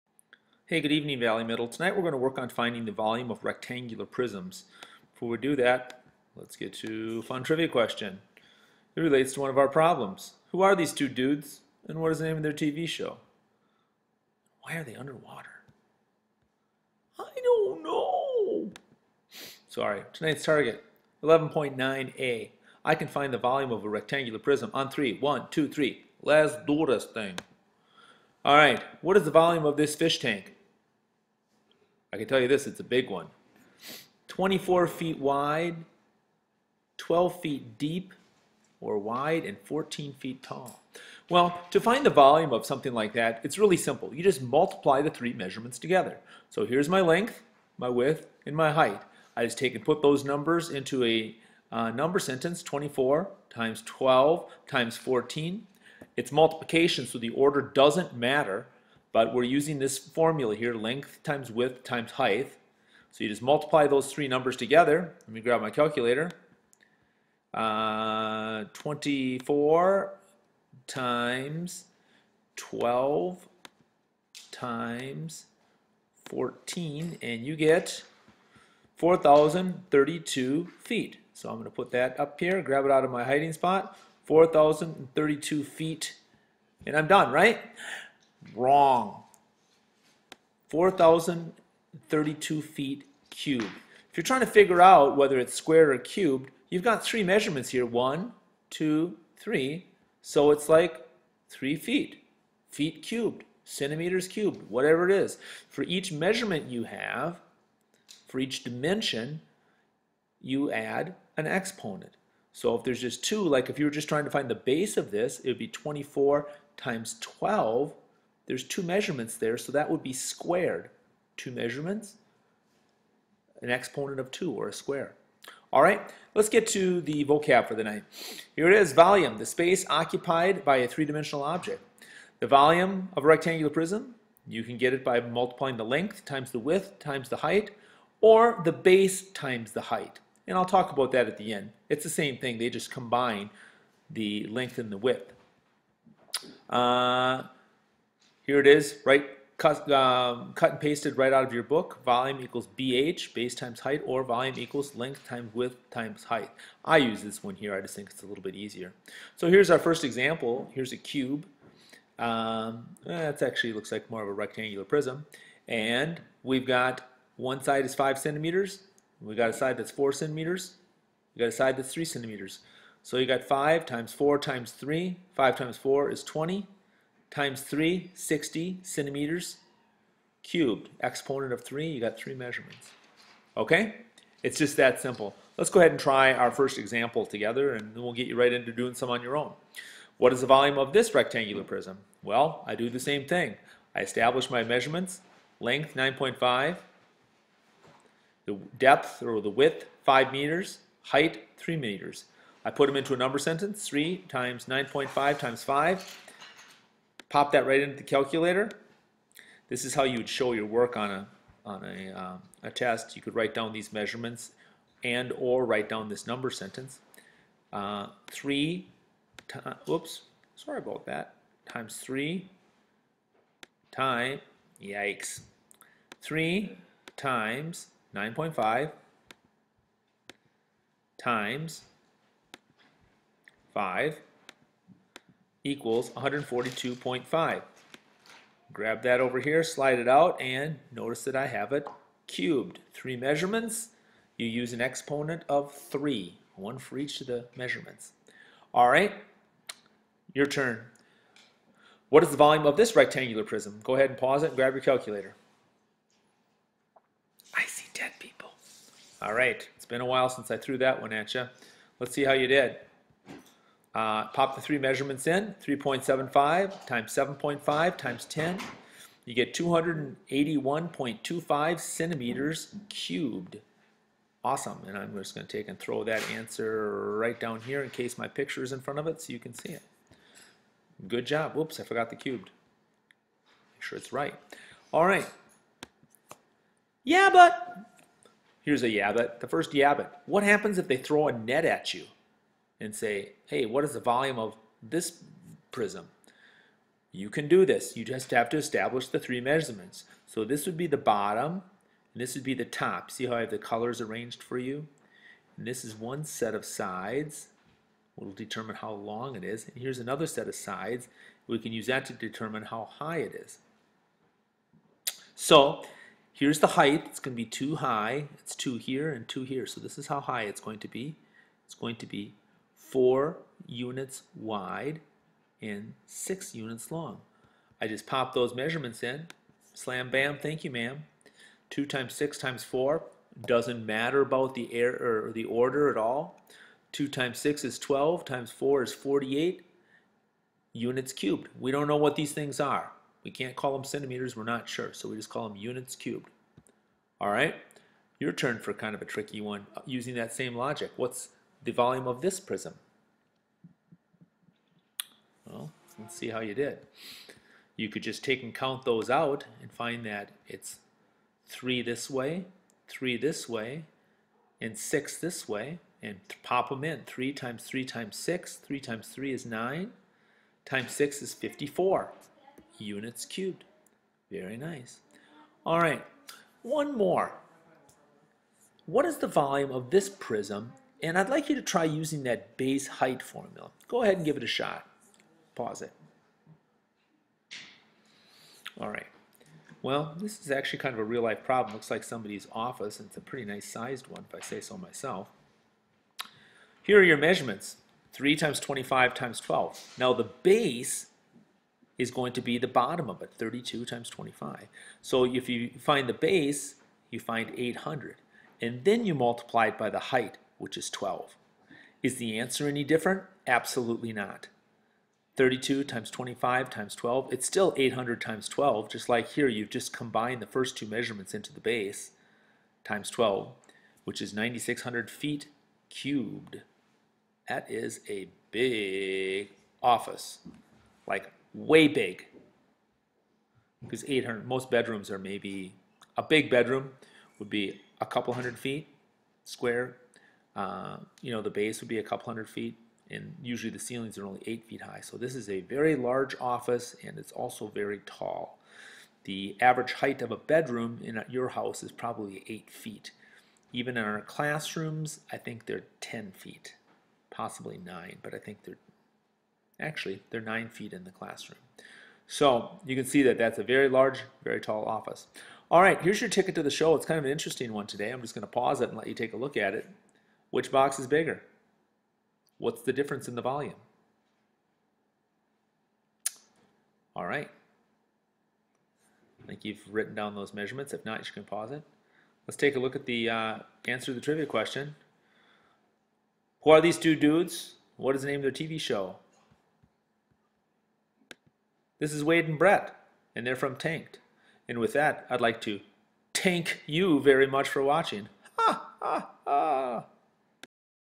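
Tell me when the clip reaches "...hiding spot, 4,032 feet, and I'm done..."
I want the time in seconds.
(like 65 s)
83 s.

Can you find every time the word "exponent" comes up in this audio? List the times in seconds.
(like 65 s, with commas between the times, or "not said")
111 s, 123 s, 181 s, 244 s.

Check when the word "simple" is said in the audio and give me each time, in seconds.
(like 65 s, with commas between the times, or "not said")
43 s, 185 s.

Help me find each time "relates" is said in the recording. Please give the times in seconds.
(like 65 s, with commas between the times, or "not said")
9 s.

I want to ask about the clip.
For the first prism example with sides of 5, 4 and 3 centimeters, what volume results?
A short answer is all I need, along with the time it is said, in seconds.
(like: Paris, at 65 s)
60 centimeters cubed, at 178 s.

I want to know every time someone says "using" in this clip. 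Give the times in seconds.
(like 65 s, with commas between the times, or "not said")
59 s, 349 s, 381 s.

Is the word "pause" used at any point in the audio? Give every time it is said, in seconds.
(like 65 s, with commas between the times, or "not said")
254 s, 385 s, 468 s, 481 s.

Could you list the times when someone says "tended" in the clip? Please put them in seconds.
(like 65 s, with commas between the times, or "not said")
not said.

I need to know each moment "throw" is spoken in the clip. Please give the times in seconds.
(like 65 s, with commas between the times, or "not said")
275 s, 290 s.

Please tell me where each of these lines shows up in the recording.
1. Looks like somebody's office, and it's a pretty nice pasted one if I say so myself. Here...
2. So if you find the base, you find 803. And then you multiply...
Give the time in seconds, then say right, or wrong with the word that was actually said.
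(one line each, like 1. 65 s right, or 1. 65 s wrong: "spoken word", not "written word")
1. 391 s wrong: "sized", not "pasted"
2. 405 s wrong: "800", not "803".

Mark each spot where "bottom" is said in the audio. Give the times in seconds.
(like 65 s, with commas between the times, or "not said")
300 s, 402 s.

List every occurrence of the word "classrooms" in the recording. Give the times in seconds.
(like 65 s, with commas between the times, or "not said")
454 s, 461 s.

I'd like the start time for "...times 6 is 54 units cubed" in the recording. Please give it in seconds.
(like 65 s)
370 s.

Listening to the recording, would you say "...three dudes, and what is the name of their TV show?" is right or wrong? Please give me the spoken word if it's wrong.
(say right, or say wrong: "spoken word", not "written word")
wrong: "two", not "three".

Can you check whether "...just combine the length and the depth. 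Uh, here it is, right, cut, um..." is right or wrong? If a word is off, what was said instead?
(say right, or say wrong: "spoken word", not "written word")
wrong: "width", not "depth".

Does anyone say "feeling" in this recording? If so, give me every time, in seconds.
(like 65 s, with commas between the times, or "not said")
not said.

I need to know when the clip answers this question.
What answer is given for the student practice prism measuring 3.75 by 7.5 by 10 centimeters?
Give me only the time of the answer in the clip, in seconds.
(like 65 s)
269 s.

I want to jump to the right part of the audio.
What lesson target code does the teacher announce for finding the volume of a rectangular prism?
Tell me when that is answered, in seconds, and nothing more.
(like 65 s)
21 s.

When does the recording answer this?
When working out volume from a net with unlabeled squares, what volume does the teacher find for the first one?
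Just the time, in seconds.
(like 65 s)
338 s.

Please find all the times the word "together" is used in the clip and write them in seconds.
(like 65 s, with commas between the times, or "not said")
45 s, 64 s, 187 s.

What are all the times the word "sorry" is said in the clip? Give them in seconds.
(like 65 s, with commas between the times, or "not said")
19 s, 220 s.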